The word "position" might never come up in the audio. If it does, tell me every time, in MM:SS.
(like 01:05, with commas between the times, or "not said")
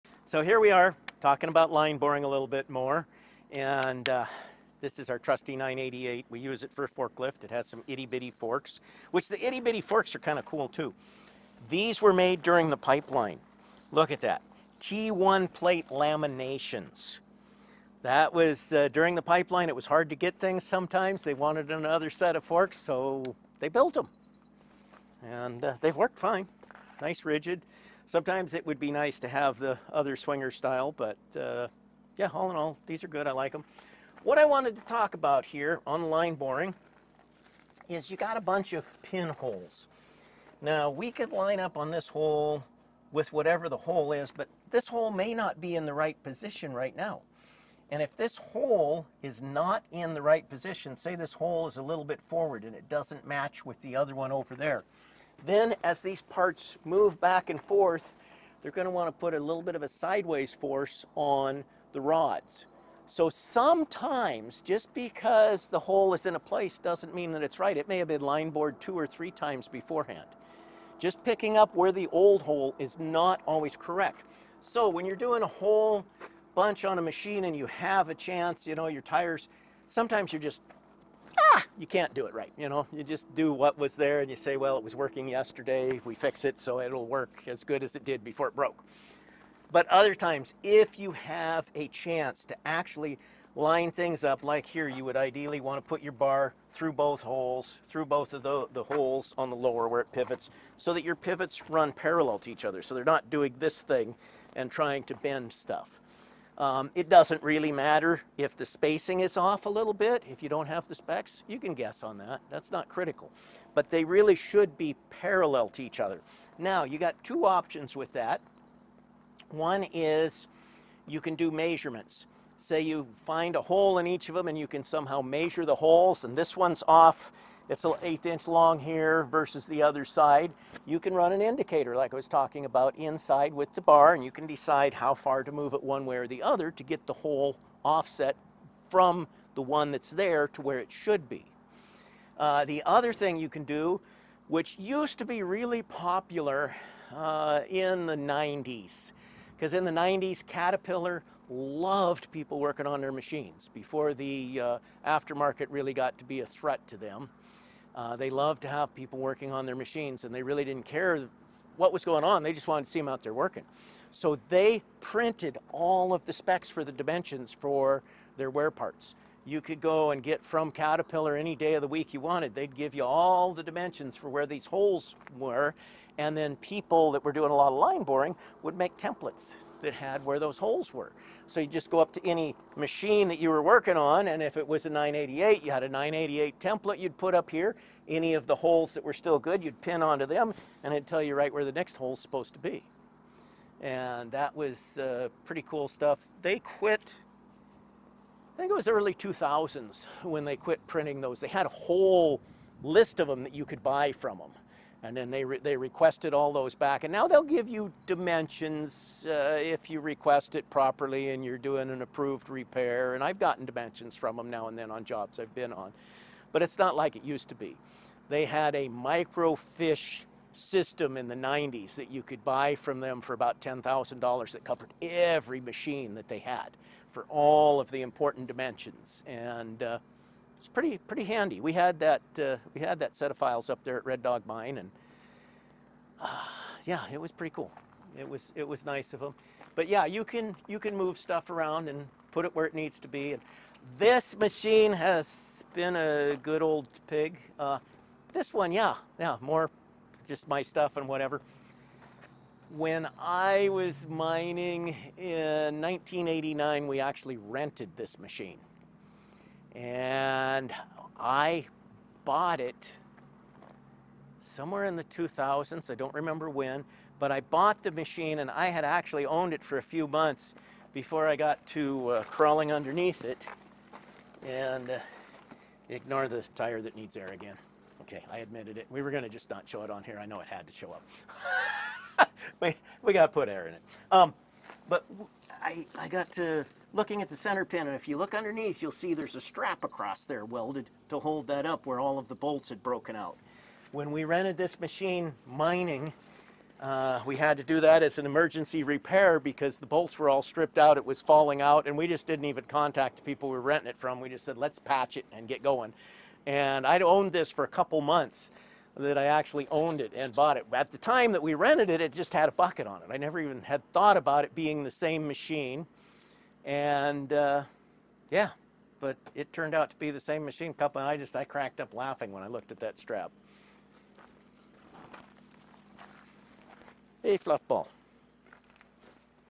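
00:46, 00:50.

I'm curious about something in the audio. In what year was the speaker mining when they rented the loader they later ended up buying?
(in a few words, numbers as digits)
1989.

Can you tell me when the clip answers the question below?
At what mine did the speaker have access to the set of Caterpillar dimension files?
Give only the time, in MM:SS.
03:54.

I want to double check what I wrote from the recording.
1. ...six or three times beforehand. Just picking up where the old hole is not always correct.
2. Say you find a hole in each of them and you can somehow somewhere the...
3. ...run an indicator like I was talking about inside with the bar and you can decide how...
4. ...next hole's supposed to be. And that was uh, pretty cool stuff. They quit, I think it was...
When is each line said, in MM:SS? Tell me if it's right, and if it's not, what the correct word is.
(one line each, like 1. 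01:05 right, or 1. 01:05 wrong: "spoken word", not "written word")
1. 01:08 wrong: "two", not "six"
2. 02:02 wrong: "measure", not "somewhere"
3. 02:11 right
4. 03:11 right.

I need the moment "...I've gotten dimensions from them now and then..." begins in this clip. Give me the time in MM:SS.
03:33.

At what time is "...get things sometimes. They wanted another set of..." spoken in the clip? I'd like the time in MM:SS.
00:20.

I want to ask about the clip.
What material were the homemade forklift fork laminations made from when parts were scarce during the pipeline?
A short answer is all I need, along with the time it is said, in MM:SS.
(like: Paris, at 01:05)
T1 plate, at 00:14.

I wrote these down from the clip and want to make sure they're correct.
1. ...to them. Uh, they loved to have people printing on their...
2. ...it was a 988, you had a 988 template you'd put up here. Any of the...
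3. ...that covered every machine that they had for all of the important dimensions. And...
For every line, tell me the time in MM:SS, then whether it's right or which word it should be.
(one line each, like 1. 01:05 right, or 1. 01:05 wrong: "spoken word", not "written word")
1. 02:36 wrong: "working", not "printing"
2. 03:04 right
3. 03:44 right.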